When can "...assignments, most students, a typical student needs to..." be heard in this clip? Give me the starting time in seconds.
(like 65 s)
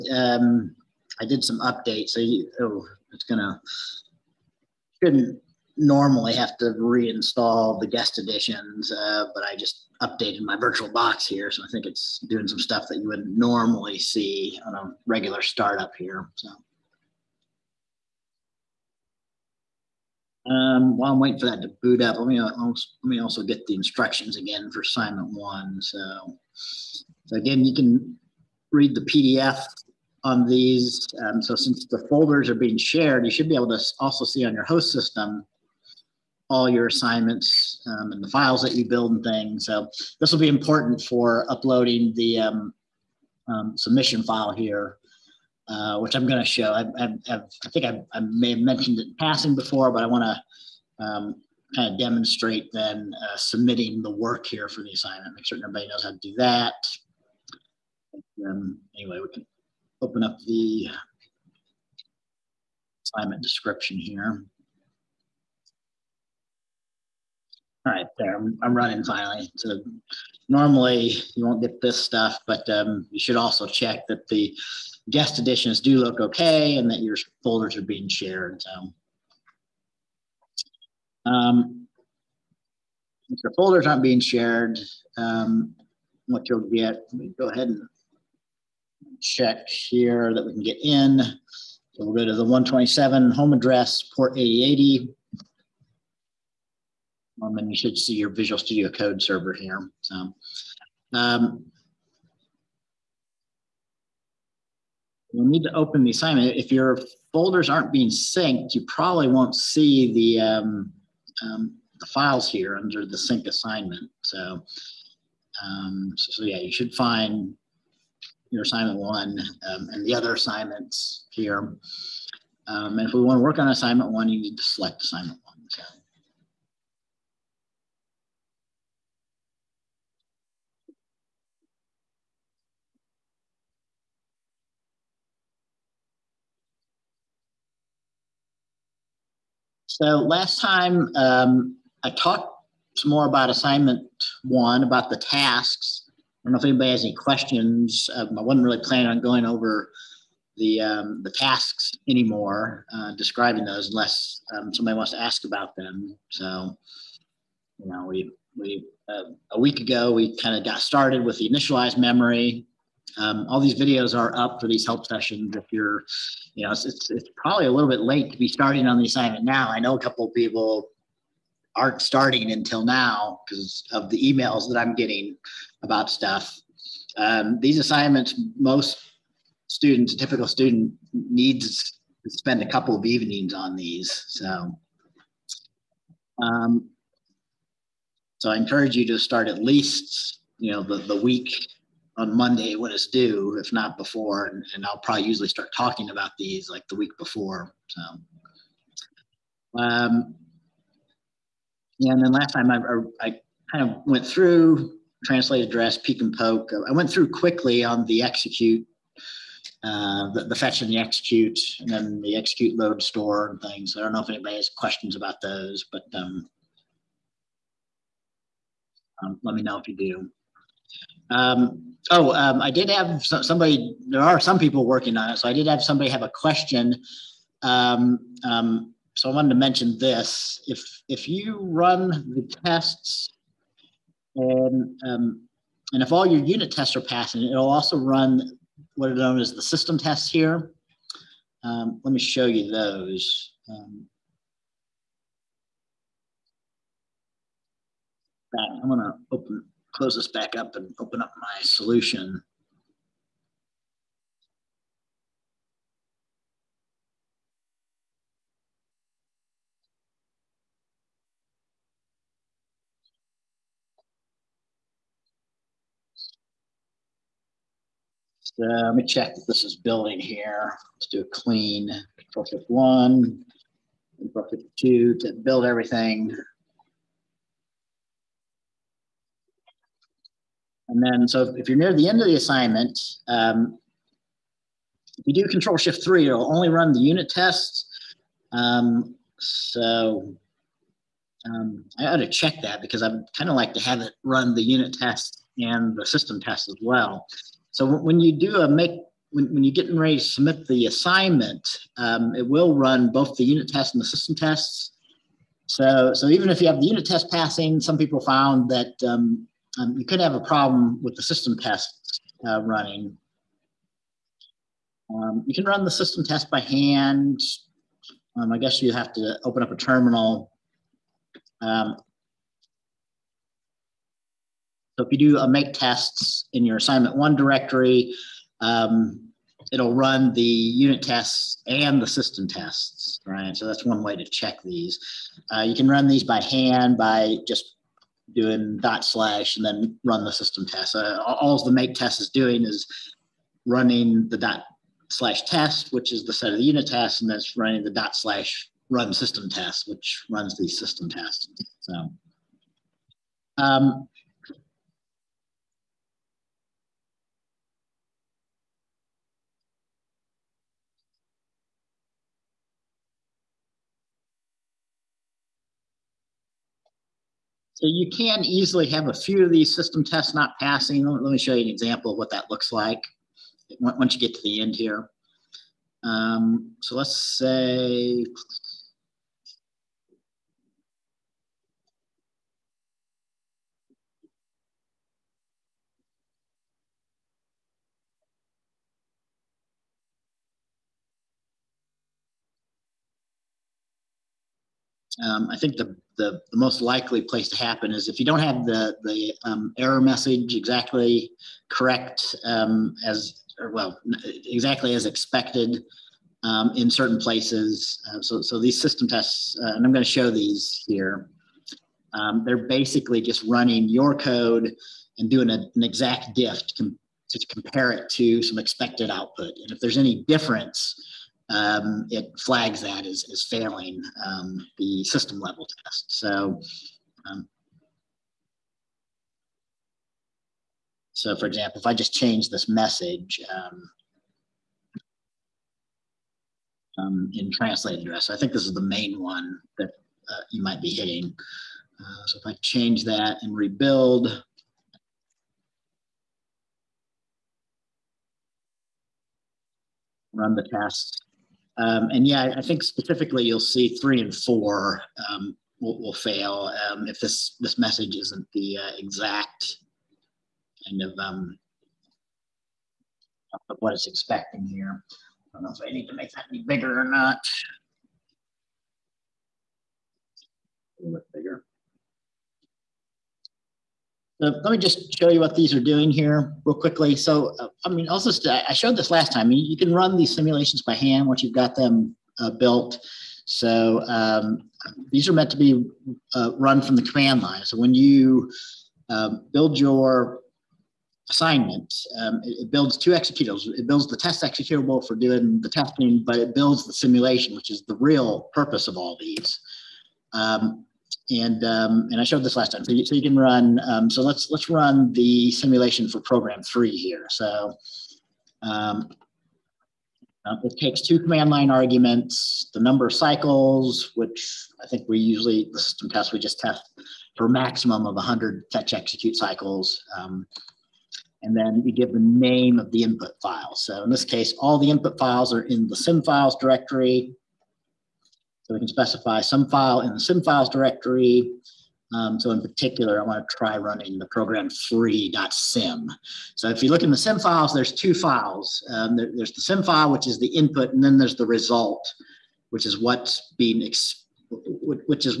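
177 s.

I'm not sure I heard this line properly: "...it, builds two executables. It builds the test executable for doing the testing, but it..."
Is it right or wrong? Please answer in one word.
right.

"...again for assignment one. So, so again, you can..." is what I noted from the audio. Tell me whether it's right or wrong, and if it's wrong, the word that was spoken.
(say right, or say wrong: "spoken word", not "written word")
right.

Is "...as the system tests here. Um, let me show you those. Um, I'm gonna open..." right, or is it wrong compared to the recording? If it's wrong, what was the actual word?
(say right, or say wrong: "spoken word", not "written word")
right.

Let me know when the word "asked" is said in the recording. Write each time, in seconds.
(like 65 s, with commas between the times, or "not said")
not said.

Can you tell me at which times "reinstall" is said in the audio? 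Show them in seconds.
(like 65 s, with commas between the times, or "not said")
6 s.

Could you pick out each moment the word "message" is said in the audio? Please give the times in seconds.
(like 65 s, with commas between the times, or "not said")
399 s, 432 s, 457 s.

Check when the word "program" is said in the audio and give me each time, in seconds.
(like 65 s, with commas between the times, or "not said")
506 s, 534 s.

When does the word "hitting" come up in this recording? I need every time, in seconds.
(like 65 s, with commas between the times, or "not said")
440 s.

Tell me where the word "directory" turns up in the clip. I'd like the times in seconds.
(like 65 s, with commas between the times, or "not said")
327 s, 526 s, 530 s.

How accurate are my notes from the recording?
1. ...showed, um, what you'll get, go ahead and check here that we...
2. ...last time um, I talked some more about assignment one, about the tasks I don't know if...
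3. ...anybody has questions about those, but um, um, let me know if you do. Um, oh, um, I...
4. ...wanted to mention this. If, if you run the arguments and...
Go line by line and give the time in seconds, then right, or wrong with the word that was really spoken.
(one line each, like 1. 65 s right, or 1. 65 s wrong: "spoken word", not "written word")
1. 84 s wrong: "shared", not "showed"
2. 140 s right
3. 214 s right
4. 229 s wrong: "tests", not "arguments".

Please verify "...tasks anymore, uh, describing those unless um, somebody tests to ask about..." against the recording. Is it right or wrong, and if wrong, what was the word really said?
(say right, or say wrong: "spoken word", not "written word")
wrong: "wants", not "tests".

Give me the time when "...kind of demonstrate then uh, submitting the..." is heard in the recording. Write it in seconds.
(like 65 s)
51 s.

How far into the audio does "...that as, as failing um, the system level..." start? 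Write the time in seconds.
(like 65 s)
422 s.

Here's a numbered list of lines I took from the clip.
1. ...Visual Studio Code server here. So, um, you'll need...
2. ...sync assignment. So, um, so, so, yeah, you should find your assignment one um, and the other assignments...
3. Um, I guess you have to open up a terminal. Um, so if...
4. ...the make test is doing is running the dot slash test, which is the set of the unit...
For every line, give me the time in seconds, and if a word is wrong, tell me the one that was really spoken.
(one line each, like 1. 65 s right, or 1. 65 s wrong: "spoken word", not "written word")
1. 98 s right
2. 113 s right
3. 318 s right
4. 341 s right.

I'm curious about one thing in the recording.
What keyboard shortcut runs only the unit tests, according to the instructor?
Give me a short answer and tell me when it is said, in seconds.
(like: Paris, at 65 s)
control shift three, at 285 s.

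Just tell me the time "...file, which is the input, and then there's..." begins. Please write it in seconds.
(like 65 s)
539 s.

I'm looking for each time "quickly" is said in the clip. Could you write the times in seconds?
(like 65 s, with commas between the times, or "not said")
207 s, 476 s.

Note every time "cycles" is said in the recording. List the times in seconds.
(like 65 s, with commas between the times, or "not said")
513 s, 519 s.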